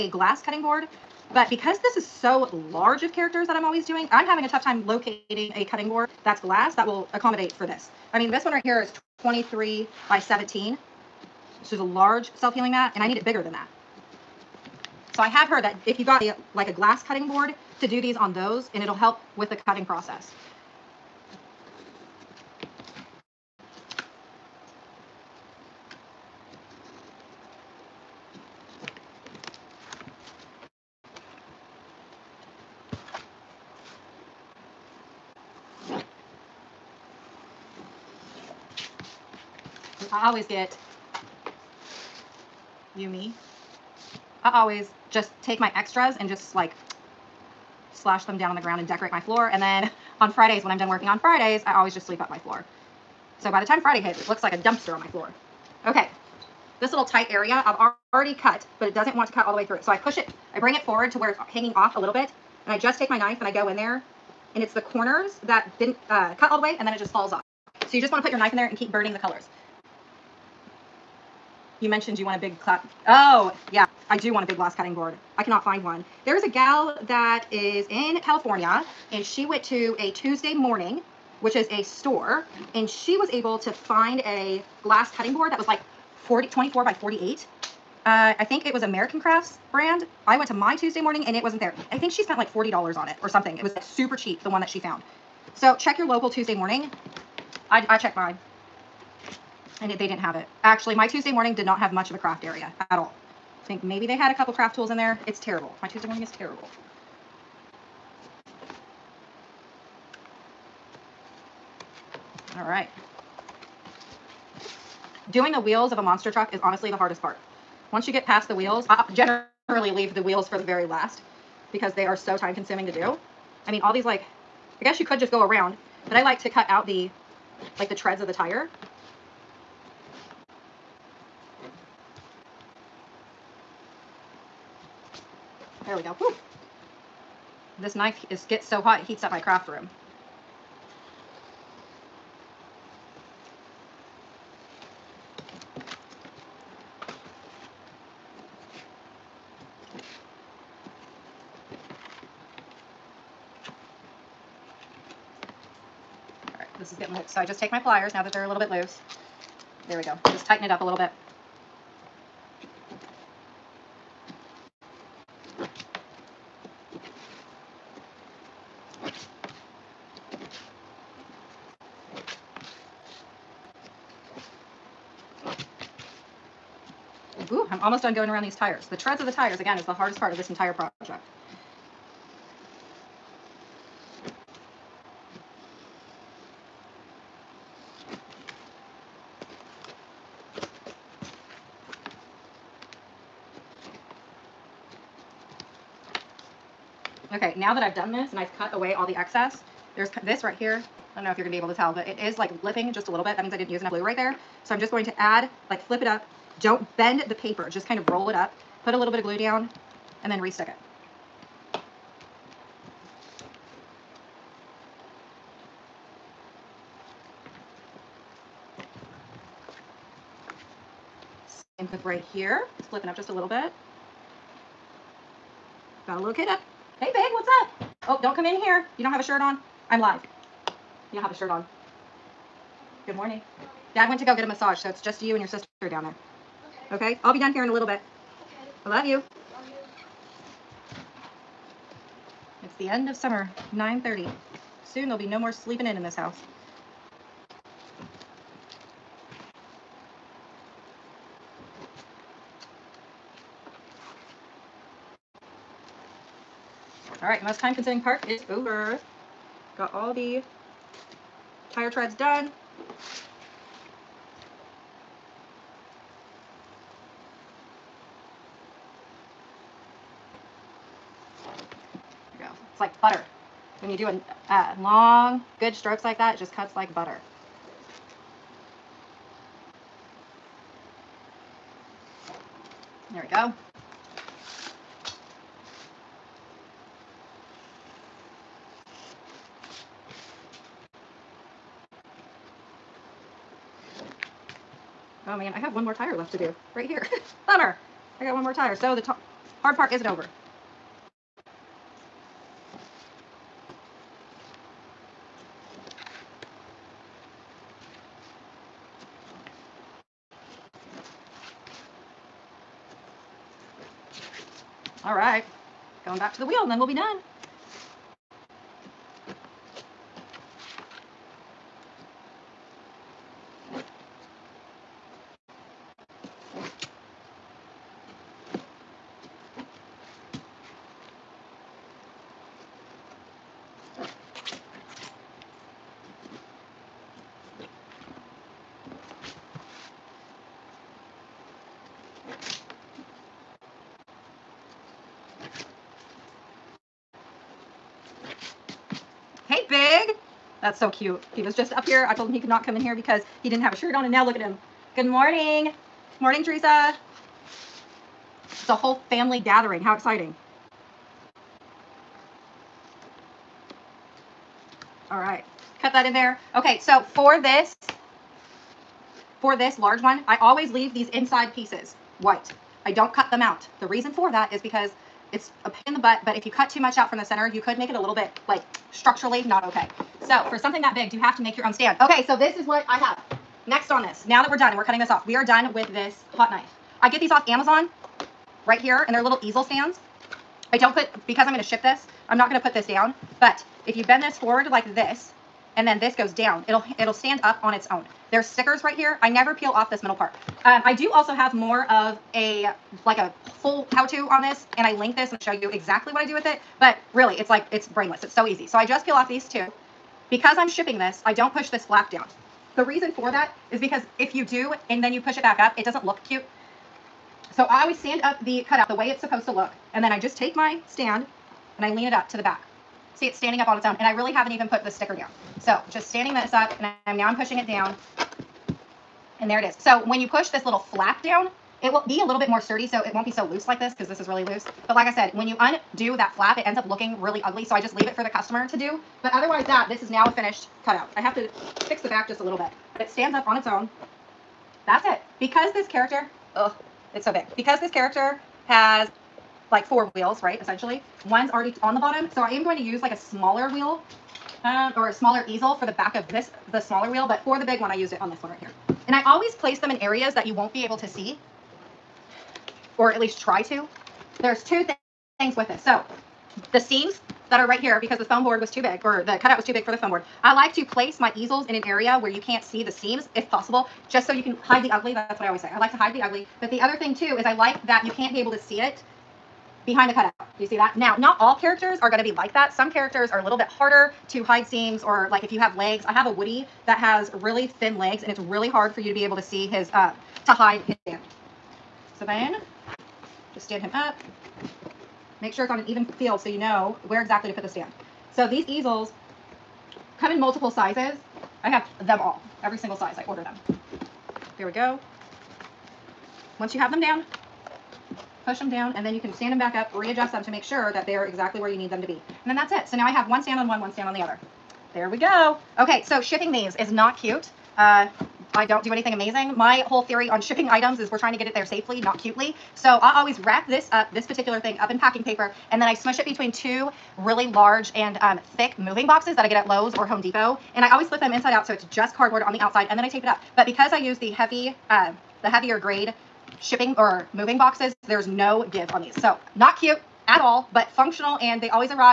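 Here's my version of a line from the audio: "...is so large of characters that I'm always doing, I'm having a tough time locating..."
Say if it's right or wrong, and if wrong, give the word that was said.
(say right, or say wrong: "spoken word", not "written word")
right.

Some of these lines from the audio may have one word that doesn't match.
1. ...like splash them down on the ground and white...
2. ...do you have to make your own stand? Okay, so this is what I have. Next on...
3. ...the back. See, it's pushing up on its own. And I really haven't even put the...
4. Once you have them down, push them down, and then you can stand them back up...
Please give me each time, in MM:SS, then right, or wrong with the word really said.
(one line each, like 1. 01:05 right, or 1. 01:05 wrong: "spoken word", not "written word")
1. 00:46 wrong: "decorate", not "white"
2. 06:21 right
3. 07:02 wrong: "standing", not "pushing"
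4. 08:26 right.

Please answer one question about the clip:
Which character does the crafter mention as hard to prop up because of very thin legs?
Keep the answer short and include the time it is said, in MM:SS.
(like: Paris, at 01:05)
Woody, at 08:06.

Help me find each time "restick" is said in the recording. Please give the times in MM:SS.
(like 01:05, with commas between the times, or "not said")
03:30.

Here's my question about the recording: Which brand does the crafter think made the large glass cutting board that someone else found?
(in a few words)
American Crafts.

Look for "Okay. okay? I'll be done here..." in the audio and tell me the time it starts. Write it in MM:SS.
03:56.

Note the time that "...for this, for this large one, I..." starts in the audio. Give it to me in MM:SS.
06:07.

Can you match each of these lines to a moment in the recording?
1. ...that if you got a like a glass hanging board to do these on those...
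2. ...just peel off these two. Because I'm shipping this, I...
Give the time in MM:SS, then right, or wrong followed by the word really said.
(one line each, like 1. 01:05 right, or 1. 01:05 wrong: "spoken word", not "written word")
1. 00:15 wrong: "cutting", not "hanging"
2. 06:48 right.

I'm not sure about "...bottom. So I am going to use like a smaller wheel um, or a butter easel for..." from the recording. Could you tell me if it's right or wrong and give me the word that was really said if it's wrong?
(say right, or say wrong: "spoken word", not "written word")
wrong: "smaller", not "butter".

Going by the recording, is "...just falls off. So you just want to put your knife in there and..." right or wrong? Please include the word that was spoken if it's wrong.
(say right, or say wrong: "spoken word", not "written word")
right.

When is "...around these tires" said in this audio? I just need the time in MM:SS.
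02:58.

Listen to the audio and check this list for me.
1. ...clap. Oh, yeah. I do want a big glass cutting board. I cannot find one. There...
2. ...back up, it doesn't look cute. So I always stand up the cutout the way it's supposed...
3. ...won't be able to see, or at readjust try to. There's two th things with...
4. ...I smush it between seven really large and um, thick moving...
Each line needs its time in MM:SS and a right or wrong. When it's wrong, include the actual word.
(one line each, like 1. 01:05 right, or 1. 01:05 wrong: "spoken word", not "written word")
1. 01:12 right
2. 06:55 right
3. 07:40 wrong: "least", not "readjust"
4. 08:45 wrong: "two", not "seven".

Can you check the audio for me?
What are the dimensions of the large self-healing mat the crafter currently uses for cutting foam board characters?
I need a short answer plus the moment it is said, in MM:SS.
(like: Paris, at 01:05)
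23 by 17, at 00:09.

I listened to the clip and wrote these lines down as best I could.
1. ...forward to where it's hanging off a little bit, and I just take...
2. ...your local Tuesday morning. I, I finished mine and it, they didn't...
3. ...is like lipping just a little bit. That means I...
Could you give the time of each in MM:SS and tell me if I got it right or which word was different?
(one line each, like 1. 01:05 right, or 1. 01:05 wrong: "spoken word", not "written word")
1. 01:00 right
2. 01:35 wrong: "checked", not "finished"
3. 03:22 right.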